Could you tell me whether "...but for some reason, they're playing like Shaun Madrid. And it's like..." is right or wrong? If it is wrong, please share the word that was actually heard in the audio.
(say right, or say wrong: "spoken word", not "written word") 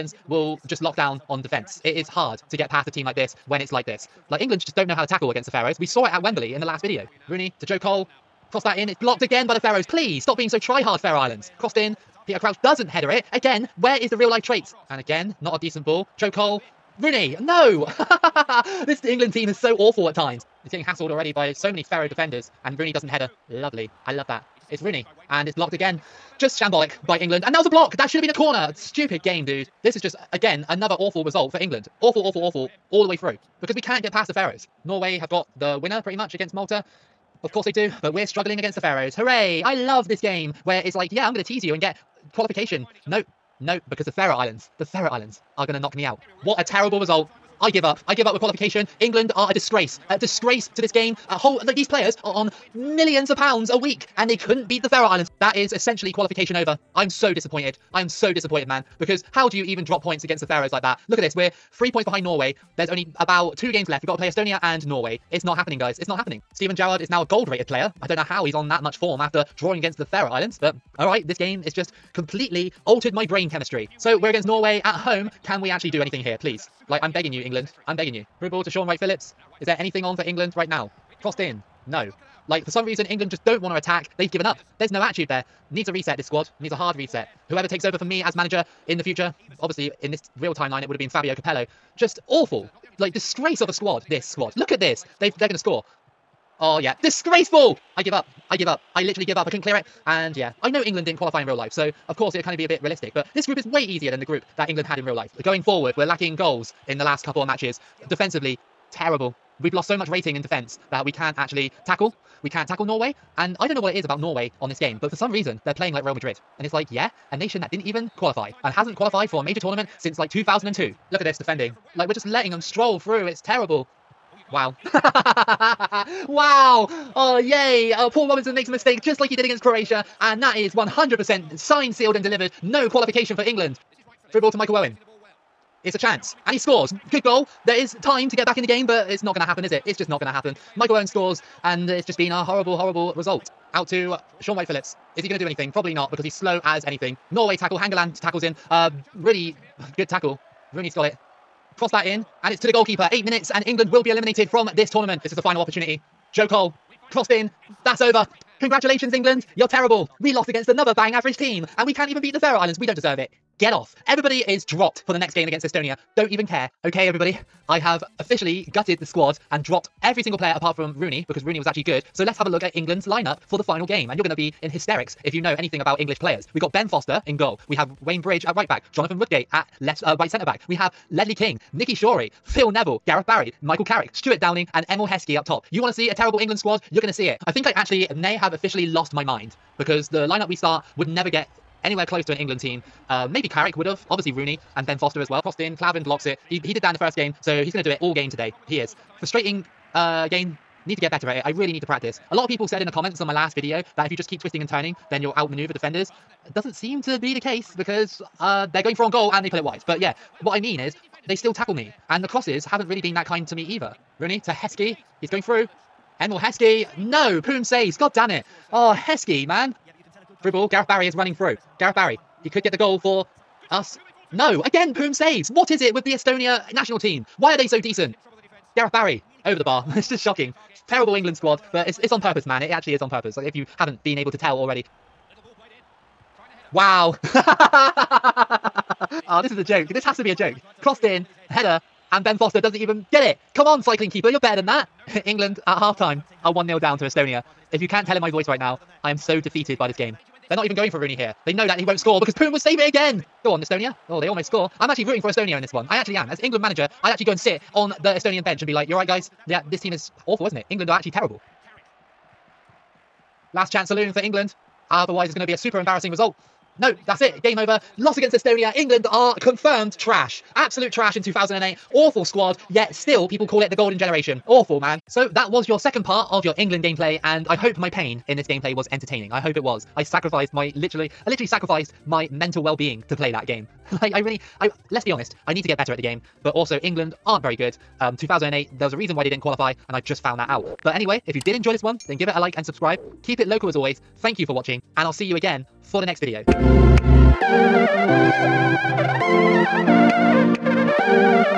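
wrong: "Real", not "Shaun".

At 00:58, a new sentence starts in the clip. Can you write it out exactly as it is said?
Because how do you even drop points against the Faroes like that?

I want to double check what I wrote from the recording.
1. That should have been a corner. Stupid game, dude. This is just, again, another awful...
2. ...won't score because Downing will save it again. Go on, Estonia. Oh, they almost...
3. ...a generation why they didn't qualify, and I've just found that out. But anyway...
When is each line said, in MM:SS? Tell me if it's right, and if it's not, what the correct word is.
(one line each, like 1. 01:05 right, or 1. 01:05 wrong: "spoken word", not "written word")
1. 00:27 right
2. 04:11 wrong: "Poom", not "Downing"
3. 04:48 wrong: "reason", not "generation".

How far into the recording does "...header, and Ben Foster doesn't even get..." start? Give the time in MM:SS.
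04:01.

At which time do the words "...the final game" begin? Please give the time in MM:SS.
02:53.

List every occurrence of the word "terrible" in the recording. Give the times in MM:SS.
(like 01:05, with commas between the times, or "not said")
00:46, 01:48, 02:03, 02:39, 03:06, 03:50, 04:21.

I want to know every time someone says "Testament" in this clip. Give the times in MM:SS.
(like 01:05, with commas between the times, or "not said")
not said.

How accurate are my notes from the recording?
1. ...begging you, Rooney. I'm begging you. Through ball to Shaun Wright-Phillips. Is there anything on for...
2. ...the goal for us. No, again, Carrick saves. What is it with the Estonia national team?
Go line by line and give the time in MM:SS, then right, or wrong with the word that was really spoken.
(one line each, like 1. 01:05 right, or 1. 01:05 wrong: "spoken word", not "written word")
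1. 01:17 wrong: "England", not "Rooney"
2. 03:42 wrong: "Poom", not "Carrick".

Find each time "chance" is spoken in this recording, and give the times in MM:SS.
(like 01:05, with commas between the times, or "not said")
02:15, 04:23.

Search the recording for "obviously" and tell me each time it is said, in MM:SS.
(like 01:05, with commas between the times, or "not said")
01:29, 03:14.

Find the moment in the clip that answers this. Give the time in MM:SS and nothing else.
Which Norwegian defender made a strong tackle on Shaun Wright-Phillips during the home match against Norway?
02:27.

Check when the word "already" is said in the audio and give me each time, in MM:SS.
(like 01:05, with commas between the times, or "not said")
00:21, 03:54.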